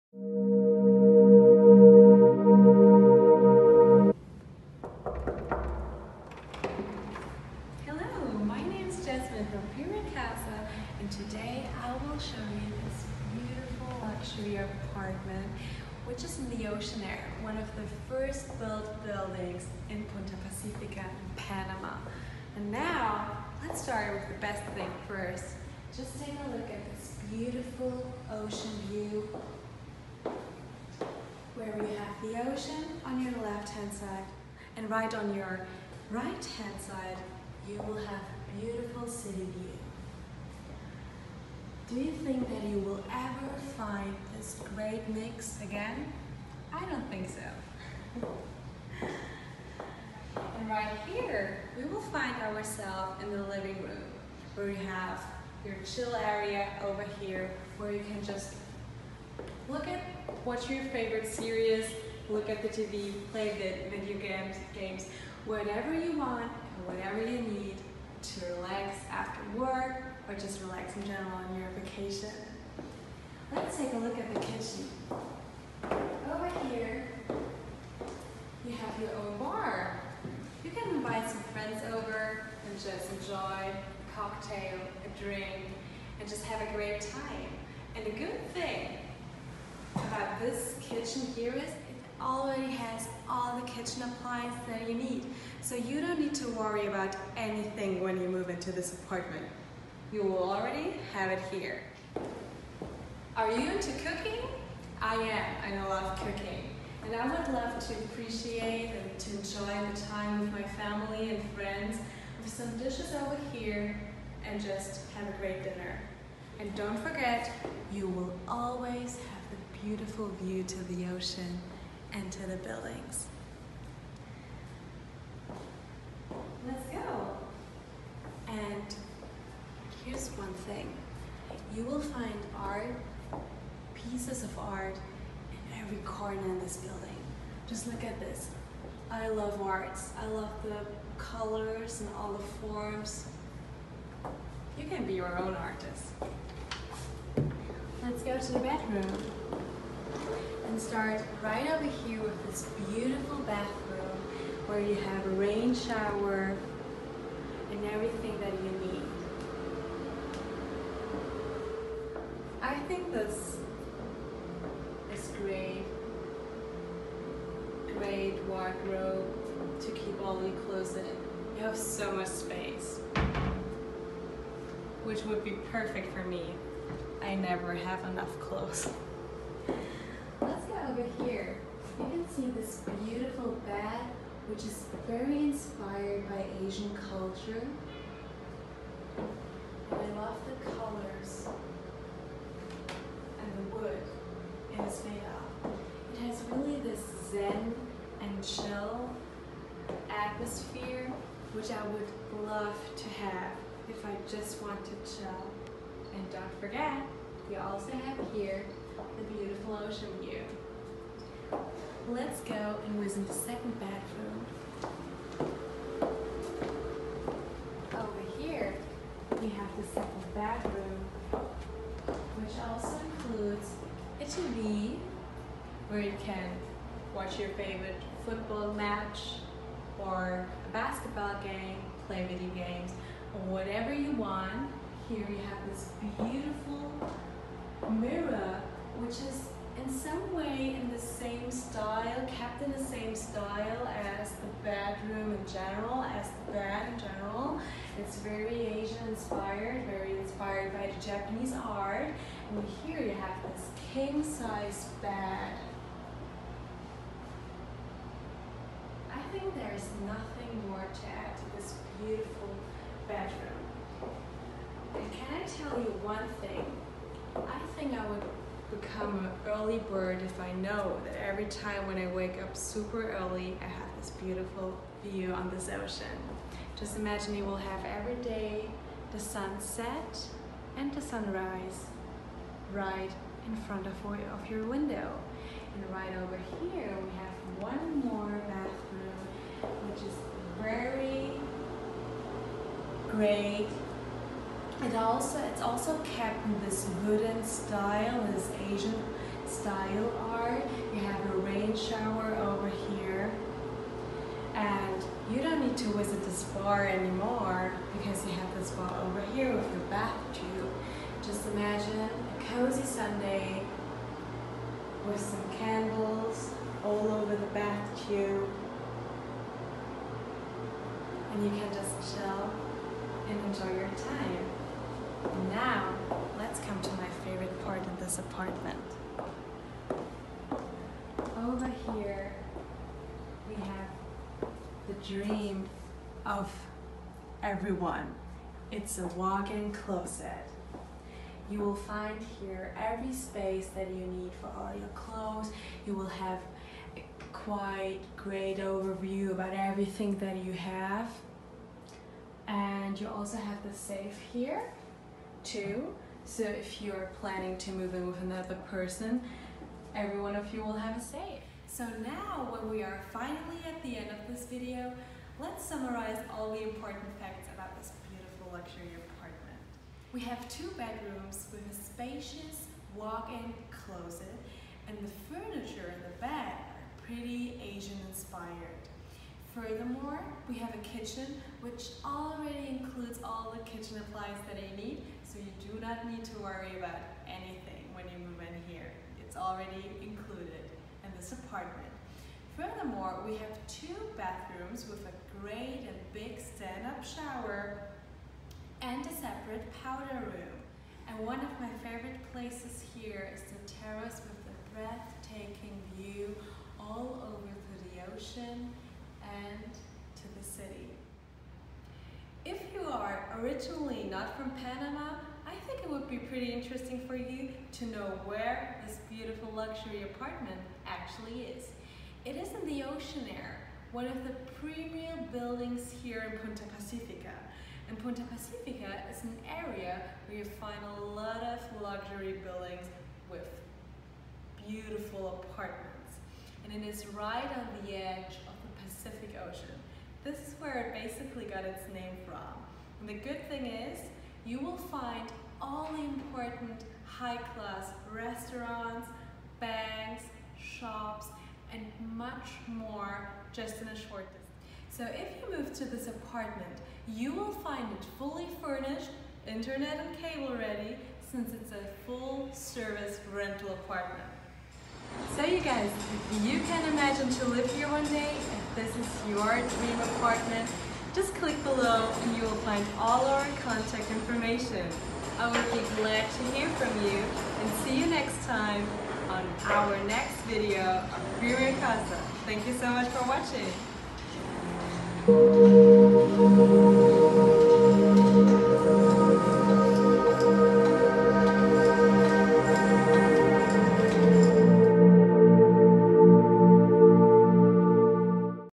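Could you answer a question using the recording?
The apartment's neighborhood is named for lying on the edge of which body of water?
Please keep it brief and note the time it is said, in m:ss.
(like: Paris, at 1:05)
Pacific Ocean, at 7:18.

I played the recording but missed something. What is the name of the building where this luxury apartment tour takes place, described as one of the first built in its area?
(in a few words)
Oceanaire.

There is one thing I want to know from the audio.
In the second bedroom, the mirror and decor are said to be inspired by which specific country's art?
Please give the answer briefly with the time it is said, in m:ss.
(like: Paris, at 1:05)
Japanese, at 4:11.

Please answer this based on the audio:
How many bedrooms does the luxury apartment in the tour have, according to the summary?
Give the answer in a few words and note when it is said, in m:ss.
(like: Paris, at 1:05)
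2, at 6:10.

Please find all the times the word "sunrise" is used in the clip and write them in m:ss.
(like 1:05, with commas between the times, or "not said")
4:41.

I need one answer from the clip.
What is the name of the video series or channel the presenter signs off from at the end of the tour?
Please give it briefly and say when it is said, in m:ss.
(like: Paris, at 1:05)
Viewing Casa, at 8:01.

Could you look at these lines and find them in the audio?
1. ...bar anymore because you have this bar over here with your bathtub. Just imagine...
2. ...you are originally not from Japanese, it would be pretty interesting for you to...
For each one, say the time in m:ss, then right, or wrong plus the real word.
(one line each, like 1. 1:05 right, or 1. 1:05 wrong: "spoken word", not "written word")
1. 5:06 right
2. 6:52 wrong: "Panama", not "Japanese".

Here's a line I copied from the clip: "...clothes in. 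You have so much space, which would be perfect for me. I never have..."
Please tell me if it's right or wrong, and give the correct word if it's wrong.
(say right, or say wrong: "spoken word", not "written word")
right.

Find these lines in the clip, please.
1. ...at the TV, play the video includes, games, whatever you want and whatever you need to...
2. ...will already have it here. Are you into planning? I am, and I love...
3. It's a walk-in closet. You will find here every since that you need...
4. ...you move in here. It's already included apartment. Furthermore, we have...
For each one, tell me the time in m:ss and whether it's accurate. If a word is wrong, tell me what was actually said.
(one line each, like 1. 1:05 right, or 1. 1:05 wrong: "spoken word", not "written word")
1. 1:02 wrong: "games", not "includes"
2. 1:40 wrong: "cooking", not "planning"
3. 5:38 wrong: "space", not "since"
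4. 6:28 right.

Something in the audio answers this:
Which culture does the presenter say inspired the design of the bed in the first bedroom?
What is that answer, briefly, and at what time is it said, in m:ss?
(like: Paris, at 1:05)
Asian culture, at 3:06.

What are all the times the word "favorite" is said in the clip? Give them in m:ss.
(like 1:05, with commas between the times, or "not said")
1:00, 3:47, 5:27, 6:41.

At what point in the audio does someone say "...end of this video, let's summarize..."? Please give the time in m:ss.
6:03.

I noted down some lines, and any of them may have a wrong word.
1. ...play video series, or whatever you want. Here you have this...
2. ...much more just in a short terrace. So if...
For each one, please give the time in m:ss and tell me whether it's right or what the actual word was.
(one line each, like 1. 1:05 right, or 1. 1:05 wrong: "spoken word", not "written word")
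1. 3:52 wrong: "games", not "series"
2. 7:32 wrong: "distance", not "terrace".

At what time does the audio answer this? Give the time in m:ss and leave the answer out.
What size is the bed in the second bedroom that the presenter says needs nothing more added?
4:13.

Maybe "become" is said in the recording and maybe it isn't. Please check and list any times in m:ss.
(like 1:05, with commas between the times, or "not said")
4:28.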